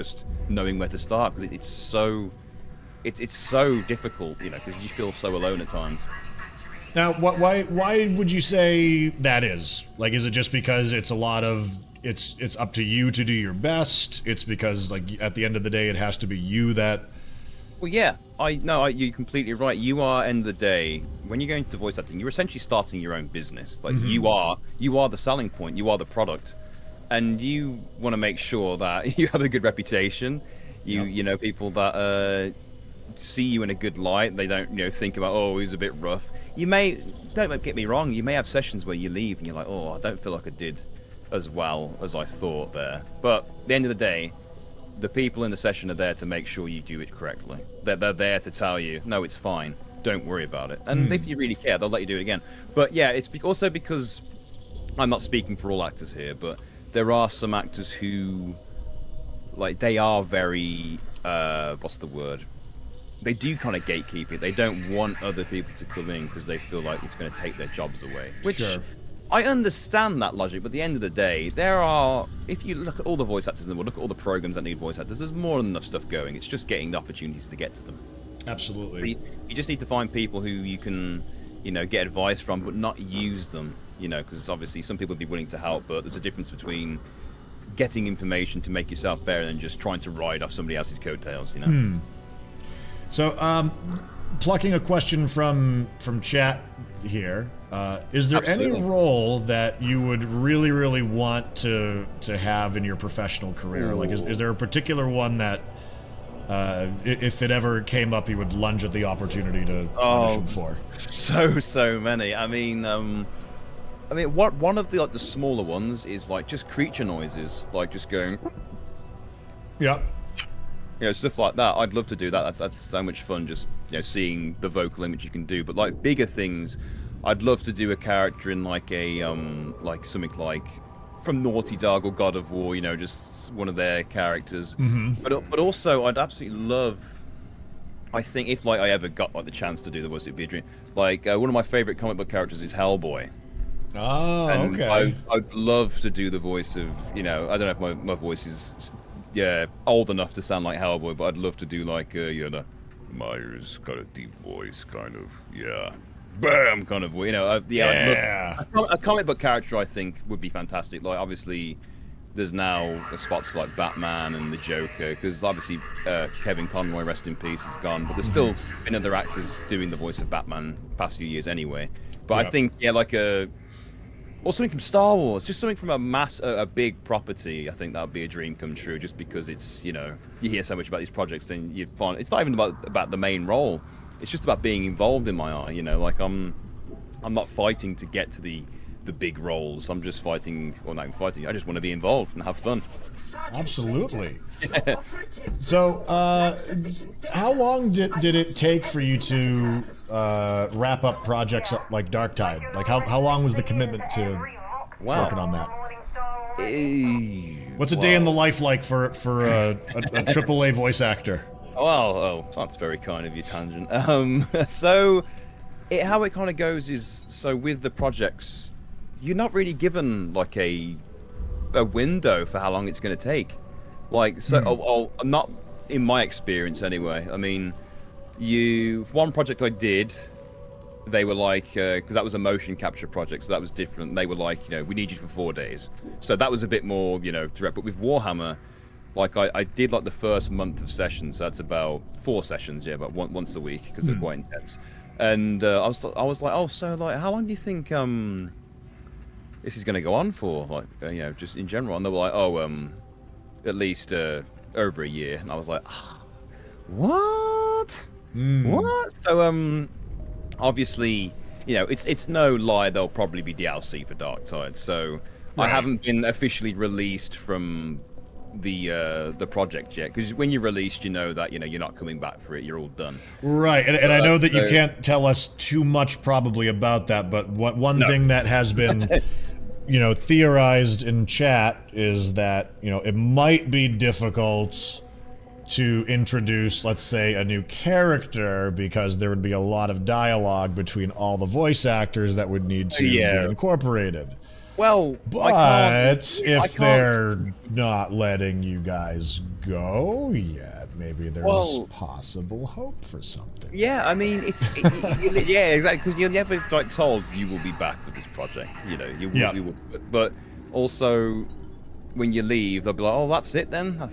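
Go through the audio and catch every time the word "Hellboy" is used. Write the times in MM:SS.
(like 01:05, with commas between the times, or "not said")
02:22, 02:30.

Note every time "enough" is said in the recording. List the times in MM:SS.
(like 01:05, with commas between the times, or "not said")
01:15, 02:30.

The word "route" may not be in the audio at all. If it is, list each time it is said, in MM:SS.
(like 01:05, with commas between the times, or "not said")
not said.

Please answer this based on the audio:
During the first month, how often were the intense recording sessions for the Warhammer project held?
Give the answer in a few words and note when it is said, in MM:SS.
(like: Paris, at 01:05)
Once a week, at 04:03.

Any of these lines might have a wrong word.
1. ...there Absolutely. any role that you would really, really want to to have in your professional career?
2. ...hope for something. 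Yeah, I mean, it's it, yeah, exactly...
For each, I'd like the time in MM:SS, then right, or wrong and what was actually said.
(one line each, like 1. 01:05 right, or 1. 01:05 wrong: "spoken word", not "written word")
1. 01:38 right
2. 05:02 right.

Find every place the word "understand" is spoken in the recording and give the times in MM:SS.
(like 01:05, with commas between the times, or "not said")
01:09.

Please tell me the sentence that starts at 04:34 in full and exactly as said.
you can't tell us too much probably about that but what one no.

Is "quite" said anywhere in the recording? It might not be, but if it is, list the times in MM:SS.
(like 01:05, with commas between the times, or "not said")
04:04.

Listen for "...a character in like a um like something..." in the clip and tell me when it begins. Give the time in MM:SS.
02:07.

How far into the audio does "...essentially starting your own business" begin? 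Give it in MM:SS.
00:22.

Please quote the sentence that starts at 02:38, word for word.
Look, a, a comic book character I think would be fantastic.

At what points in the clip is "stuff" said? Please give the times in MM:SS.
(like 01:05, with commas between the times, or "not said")
01:15, 02:01.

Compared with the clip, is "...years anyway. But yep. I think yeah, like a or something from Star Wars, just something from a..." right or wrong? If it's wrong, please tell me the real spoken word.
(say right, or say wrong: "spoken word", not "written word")
right.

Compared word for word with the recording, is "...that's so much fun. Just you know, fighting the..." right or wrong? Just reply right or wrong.
wrong.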